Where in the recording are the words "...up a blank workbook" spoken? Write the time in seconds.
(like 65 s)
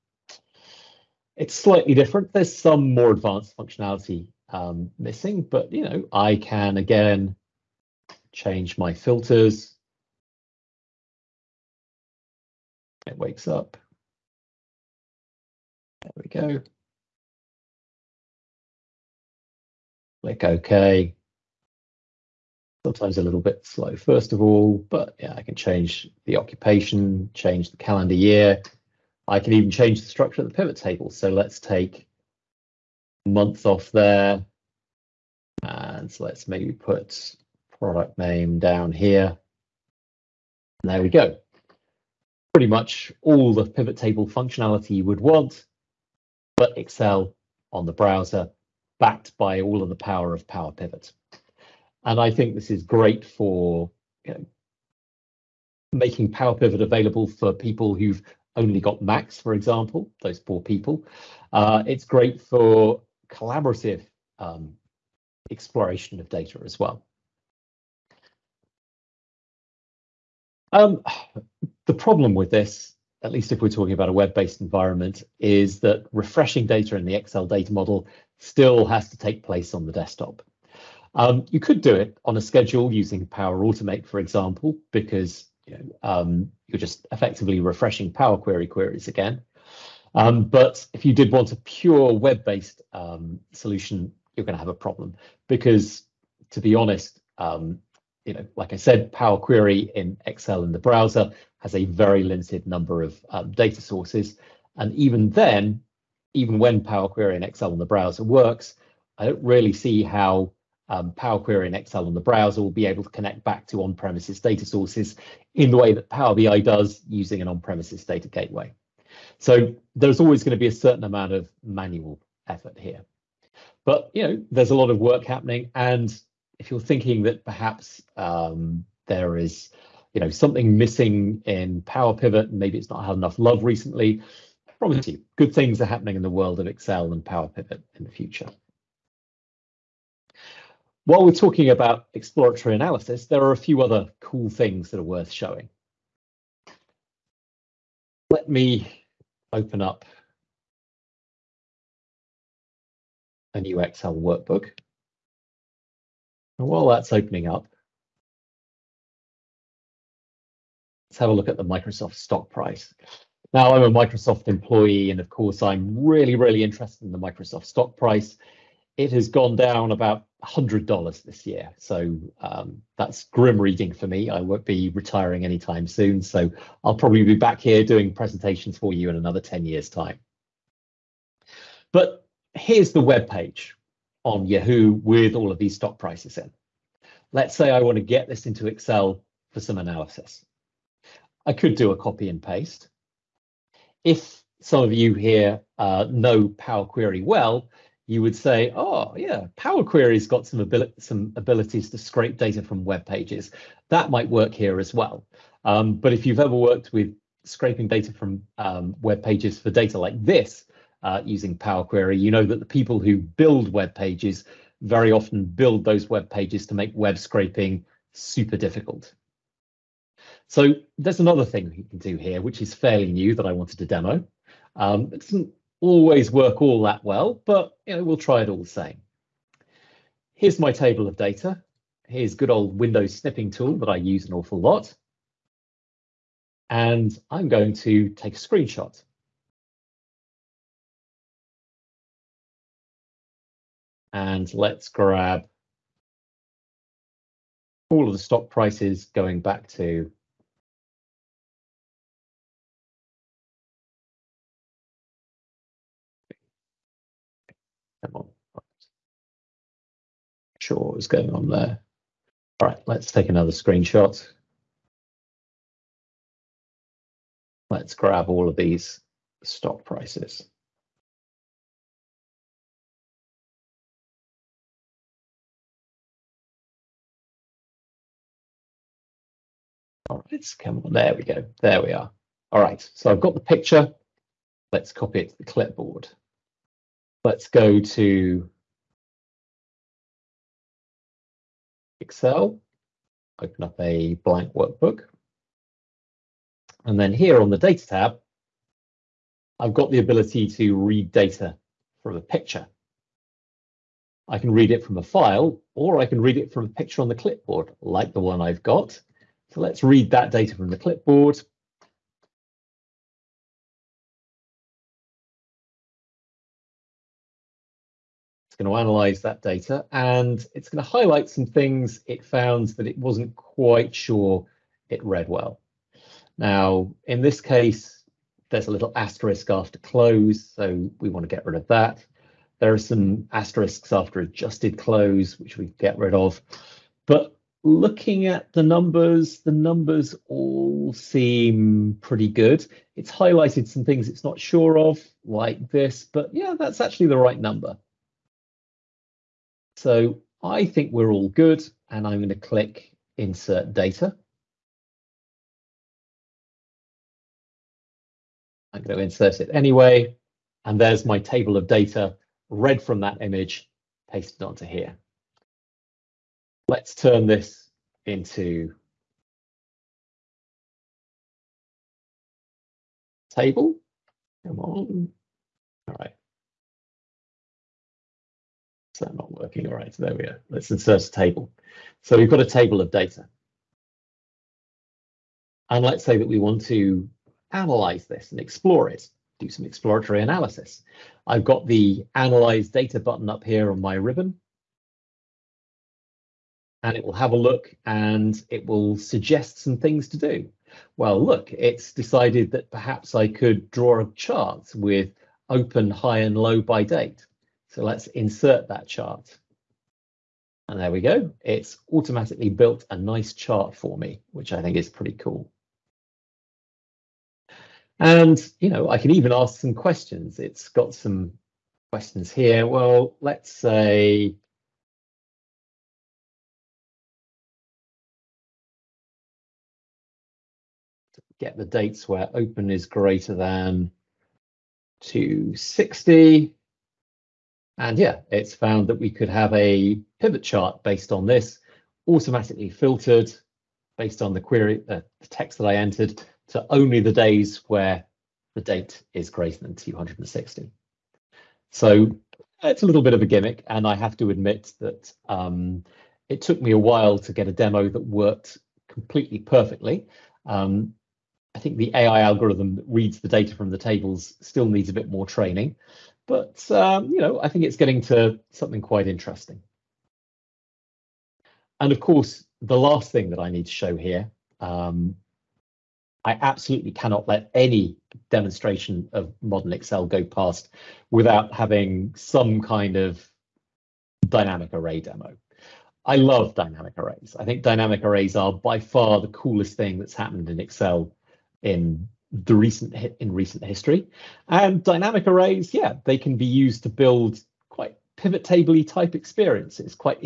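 293 s.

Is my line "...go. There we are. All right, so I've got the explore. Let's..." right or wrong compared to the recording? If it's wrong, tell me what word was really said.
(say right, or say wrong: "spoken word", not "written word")
wrong: "picture", not "explore".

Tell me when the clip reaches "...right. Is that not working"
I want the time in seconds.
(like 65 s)
375 s.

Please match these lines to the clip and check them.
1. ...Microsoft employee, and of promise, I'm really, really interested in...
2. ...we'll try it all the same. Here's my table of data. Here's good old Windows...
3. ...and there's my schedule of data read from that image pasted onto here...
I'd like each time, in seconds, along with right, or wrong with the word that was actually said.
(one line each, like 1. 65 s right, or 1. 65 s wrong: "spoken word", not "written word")
1. 163 s wrong: "course", not "promise"
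2. 228 s right
3. 360 s wrong: "table", not "schedule".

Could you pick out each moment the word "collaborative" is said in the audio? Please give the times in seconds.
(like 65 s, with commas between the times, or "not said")
63 s.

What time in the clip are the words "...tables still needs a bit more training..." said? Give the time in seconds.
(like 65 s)
463 s.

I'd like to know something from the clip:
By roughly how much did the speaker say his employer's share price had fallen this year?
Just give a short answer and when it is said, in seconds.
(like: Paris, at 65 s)
$100, at 170 s.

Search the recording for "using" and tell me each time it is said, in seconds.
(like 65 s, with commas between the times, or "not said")
82 s, 117 s, 211 s.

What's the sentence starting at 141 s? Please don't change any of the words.
While we're talking about exploratory analysis, there are a few other cool things that are worth showing.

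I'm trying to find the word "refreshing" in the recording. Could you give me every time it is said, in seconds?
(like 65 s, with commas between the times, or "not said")
76 s, 87 s.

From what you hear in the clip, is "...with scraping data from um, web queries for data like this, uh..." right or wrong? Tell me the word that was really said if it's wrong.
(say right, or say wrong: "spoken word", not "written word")
wrong: "pages", not "queries".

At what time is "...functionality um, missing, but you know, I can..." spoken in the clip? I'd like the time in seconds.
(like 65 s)
3 s.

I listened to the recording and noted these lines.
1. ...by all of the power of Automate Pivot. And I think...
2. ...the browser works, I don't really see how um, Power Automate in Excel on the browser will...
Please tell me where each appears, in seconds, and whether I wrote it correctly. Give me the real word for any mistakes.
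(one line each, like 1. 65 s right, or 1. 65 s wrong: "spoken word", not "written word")
1. 49 s wrong: "Power", not "Automate"
2. 107 s wrong: "Query", not "Automate".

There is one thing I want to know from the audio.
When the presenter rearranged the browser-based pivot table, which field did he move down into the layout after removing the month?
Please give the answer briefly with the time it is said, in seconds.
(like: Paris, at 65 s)
Product name, at 37 s.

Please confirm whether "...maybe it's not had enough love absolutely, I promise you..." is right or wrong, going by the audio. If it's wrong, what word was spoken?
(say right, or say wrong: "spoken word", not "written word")
wrong: "recently", not "absolutely".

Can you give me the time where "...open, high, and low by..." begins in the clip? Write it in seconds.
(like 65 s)
405 s.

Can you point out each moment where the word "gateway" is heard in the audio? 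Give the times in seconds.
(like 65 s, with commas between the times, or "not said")
118 s.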